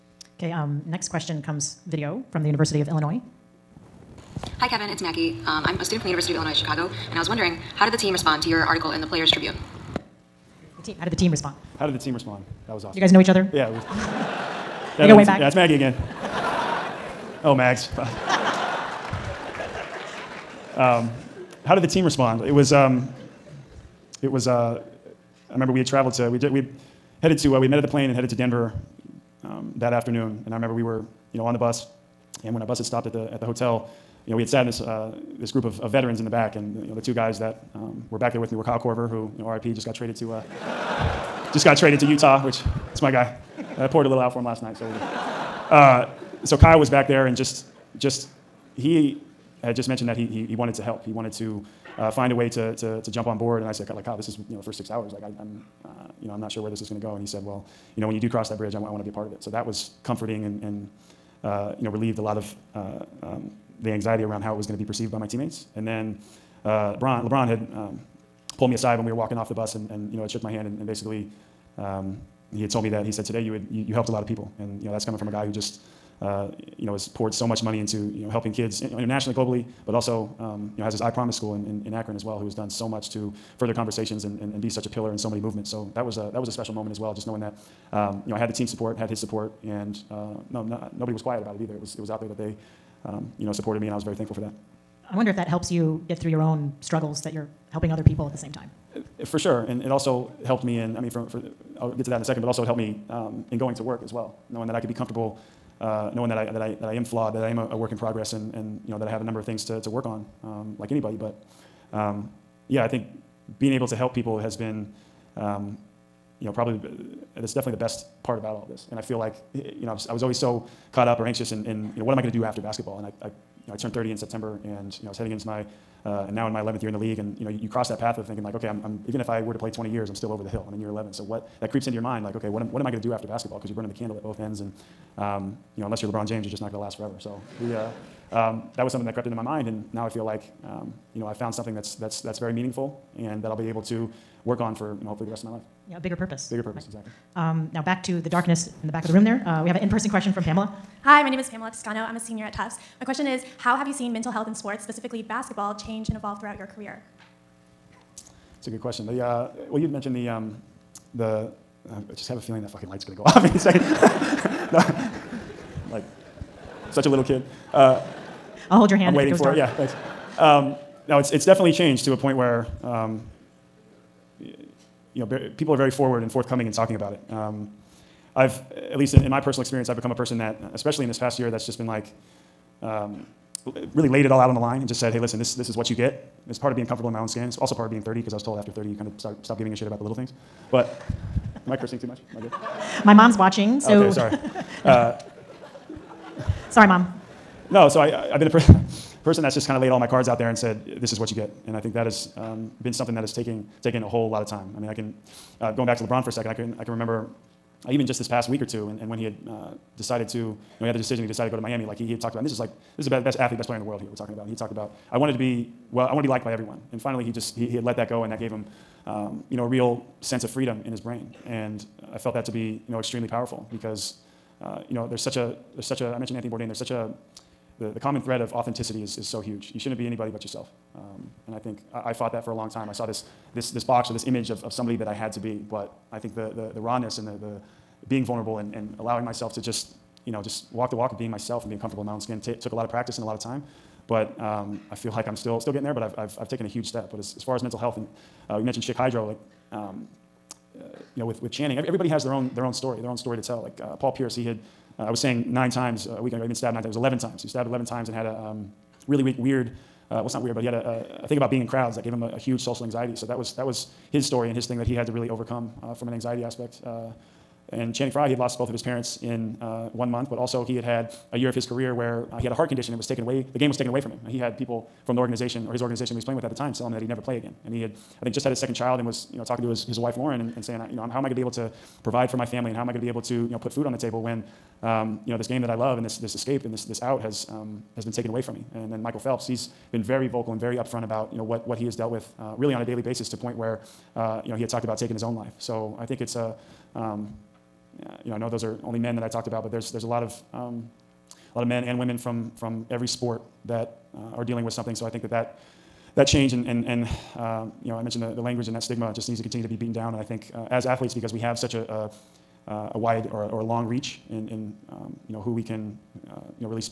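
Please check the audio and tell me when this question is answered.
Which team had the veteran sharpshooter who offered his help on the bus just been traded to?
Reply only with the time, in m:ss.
0:42.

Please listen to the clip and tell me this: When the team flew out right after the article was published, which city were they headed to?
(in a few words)
Denver.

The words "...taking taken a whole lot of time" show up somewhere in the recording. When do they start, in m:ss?
3:23.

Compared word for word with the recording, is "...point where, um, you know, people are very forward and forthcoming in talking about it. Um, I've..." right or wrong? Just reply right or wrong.
right.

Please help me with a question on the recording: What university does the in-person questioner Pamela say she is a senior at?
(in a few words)
Tufts.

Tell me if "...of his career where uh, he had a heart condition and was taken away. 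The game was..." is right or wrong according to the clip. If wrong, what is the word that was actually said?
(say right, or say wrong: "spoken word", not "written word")
right.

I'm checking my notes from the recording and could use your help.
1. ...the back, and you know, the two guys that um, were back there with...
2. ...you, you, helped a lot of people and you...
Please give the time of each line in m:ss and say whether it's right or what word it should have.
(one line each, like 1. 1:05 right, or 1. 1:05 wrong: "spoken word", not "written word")
1. 0:36 right
2. 1:13 right.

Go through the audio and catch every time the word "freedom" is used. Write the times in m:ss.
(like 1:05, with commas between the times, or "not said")
3:40.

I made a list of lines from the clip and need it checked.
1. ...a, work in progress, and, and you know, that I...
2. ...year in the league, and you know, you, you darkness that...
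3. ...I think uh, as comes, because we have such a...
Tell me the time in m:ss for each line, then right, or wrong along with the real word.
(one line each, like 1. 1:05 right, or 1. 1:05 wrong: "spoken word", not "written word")
1. 1:47 right
2. 2:06 wrong: "cross", not "darkness"
3. 5:10 wrong: "athletes", not "comes".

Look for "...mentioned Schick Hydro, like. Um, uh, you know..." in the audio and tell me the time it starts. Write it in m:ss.
4:08.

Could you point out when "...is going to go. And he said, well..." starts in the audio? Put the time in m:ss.
0:56.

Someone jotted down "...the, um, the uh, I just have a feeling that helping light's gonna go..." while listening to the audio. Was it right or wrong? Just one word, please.
wrong.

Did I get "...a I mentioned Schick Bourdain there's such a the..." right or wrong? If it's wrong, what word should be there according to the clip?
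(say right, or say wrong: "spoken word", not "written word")
wrong: "Anthony", not "Schick".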